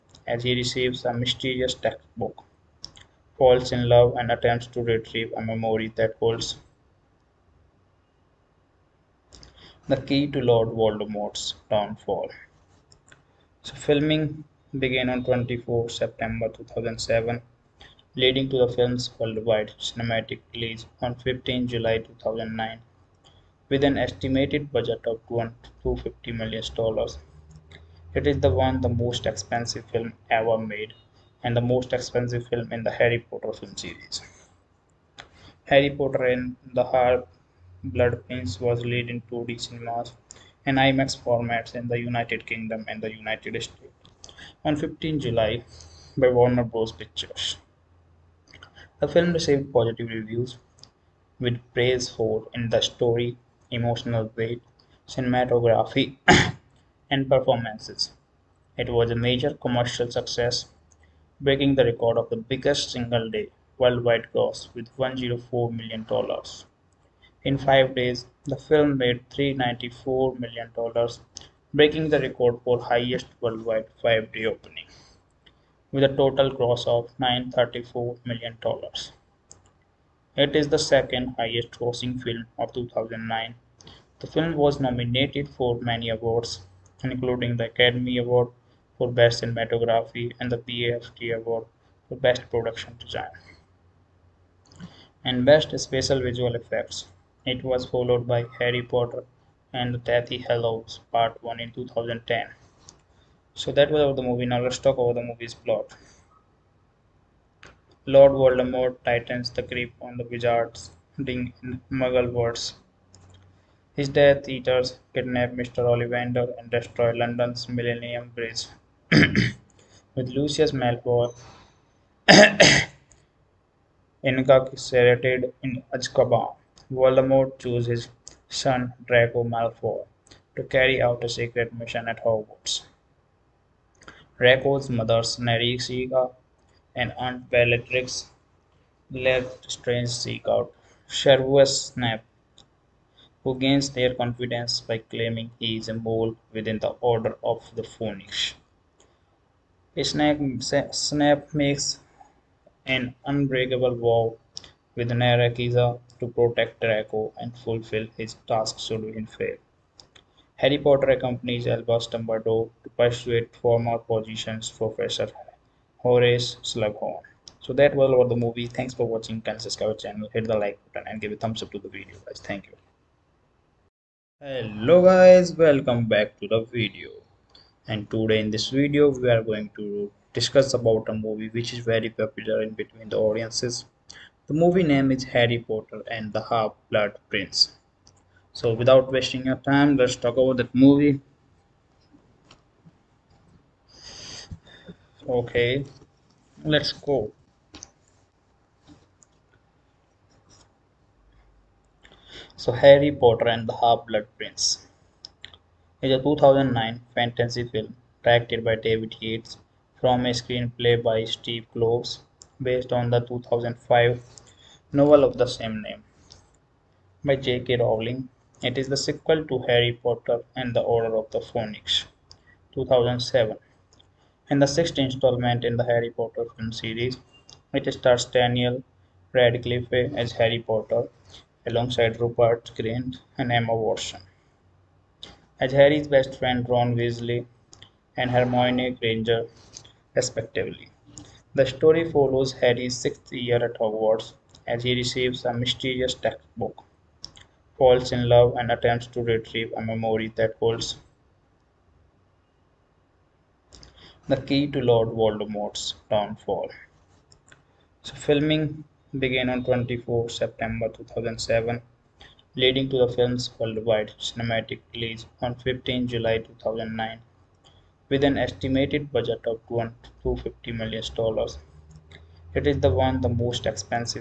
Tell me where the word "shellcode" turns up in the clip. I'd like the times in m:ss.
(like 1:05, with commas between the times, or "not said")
not said.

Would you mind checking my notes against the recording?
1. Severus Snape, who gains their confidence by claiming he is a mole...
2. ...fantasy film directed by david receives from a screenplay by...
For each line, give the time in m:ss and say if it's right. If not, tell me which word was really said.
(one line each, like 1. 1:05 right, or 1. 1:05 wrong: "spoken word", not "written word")
1. 2:21 right
2. 3:27 wrong: "yates", not "receives".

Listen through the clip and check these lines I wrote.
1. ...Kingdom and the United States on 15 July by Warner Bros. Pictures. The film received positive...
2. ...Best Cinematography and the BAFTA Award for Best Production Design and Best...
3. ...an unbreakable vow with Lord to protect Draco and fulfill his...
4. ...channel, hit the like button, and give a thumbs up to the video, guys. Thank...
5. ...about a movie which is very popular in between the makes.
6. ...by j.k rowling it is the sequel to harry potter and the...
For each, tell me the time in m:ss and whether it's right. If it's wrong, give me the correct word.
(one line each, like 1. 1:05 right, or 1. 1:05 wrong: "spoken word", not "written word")
1. 0:42 right
2. 1:29 right
3. 2:32 wrong: "Narcissa", not "Lord"
4. 2:50 right
5. 3:00 wrong: "audiences", not "makes"
6. 3:37 right.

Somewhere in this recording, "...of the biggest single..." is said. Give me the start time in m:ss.
1:02.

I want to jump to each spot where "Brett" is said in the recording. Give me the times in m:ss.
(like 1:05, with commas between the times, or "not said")
not said.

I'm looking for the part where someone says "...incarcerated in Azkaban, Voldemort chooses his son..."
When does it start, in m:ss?
2:04.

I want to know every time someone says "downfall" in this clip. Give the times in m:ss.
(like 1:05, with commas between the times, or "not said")
0:11, 4:16.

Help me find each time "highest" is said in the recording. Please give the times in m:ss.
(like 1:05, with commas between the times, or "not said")
1:12, 1:21.